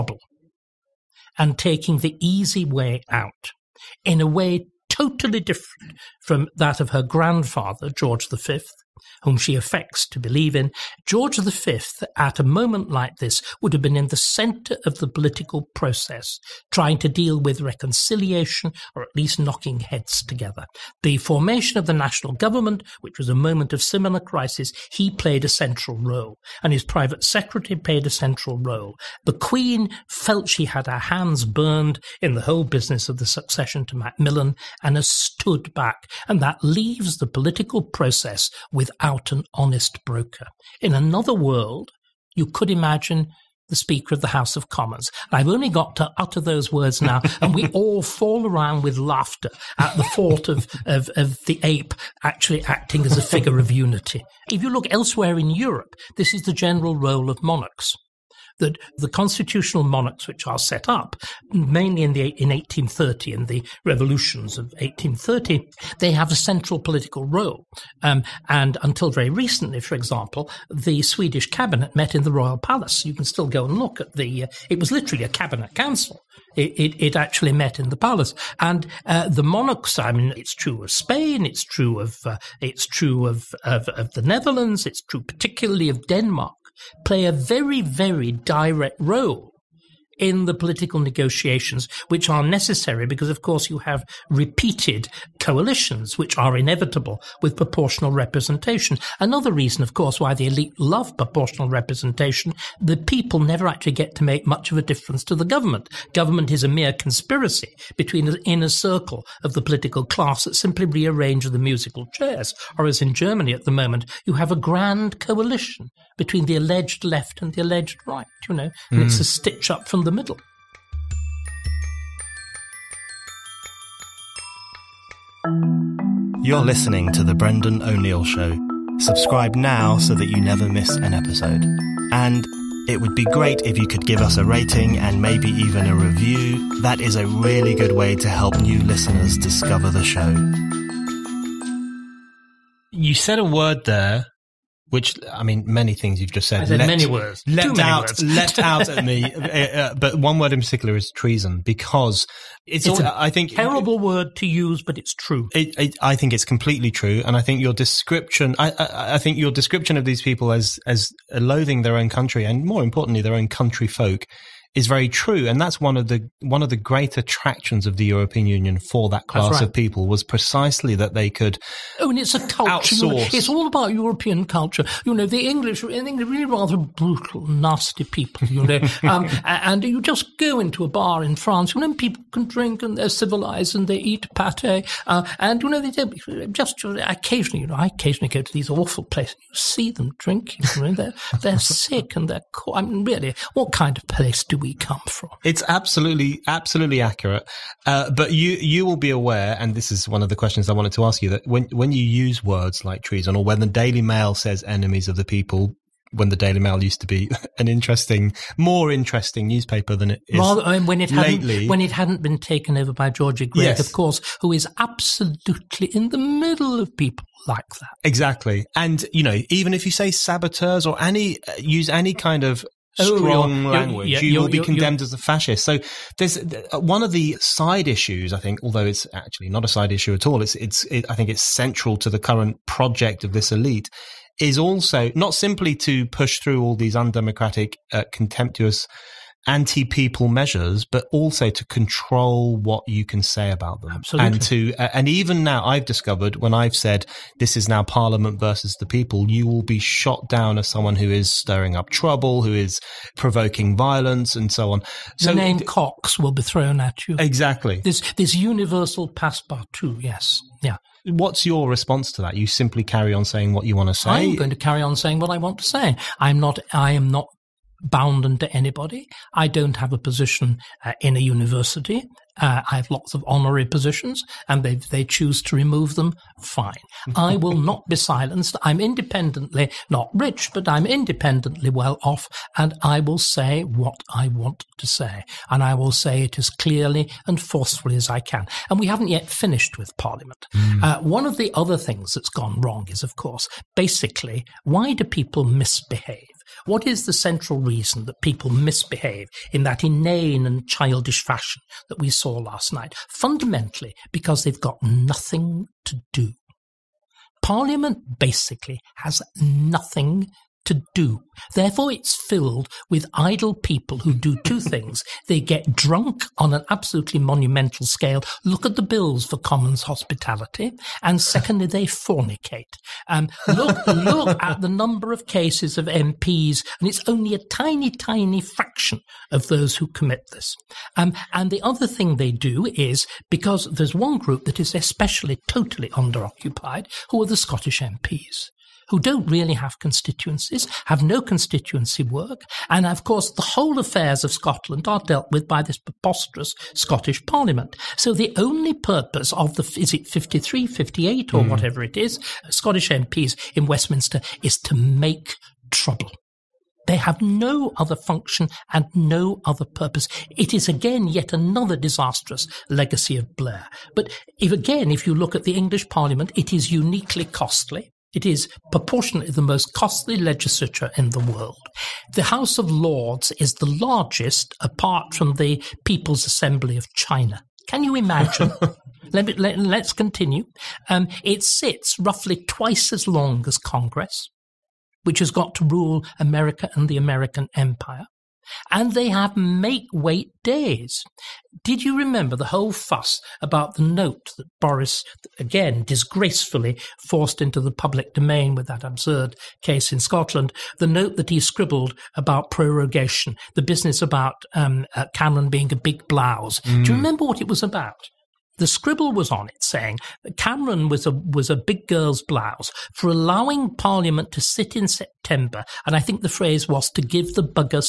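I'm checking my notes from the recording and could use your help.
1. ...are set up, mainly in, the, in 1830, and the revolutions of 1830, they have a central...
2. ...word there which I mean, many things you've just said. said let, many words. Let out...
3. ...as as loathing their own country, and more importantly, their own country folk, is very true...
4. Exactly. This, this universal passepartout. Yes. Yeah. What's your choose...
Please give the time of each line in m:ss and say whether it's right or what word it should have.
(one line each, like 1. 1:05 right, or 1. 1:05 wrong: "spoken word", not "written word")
1. 1:00 right
2. 2:23 right
3. 2:40 right
4. 4:17 wrong: "response", not "choose".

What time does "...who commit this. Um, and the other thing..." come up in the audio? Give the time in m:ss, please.
5:29.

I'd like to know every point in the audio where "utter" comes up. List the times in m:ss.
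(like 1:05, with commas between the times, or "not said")
0:46.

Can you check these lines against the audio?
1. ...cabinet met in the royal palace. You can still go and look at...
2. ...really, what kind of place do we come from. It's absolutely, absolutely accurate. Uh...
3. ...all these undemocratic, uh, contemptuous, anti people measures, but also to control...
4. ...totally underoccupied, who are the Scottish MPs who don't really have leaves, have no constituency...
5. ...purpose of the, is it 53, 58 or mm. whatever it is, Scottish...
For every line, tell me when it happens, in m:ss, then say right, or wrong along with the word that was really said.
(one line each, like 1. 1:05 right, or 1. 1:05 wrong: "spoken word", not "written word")
1. 1:11 right
2. 3:13 right
3. 3:56 right
4. 5:35 wrong: "constituencies", not "leaves"
5. 5:48 right.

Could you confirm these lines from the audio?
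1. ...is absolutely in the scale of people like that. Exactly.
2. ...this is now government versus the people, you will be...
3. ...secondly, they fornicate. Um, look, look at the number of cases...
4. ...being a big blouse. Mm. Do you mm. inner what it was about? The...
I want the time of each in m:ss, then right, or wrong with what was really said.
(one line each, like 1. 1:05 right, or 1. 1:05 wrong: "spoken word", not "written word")
1. 3:34 wrong: "middle", not "scale"
2. 4:07 wrong: "parliament", not "government"
3. 5:21 right
4. 6:45 wrong: "remember", not "inner".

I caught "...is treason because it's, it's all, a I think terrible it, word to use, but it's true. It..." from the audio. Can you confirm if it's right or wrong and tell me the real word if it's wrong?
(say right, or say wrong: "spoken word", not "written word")
right.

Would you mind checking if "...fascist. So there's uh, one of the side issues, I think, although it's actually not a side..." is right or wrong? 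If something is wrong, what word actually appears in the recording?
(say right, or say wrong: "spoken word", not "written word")
right.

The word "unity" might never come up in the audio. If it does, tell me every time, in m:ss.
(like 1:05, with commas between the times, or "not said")
0:53.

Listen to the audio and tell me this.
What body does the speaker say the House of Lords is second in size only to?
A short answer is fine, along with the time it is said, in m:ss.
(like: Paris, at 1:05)
People's Assembly of China, at 6:15.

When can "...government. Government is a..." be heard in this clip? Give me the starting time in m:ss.
1:45.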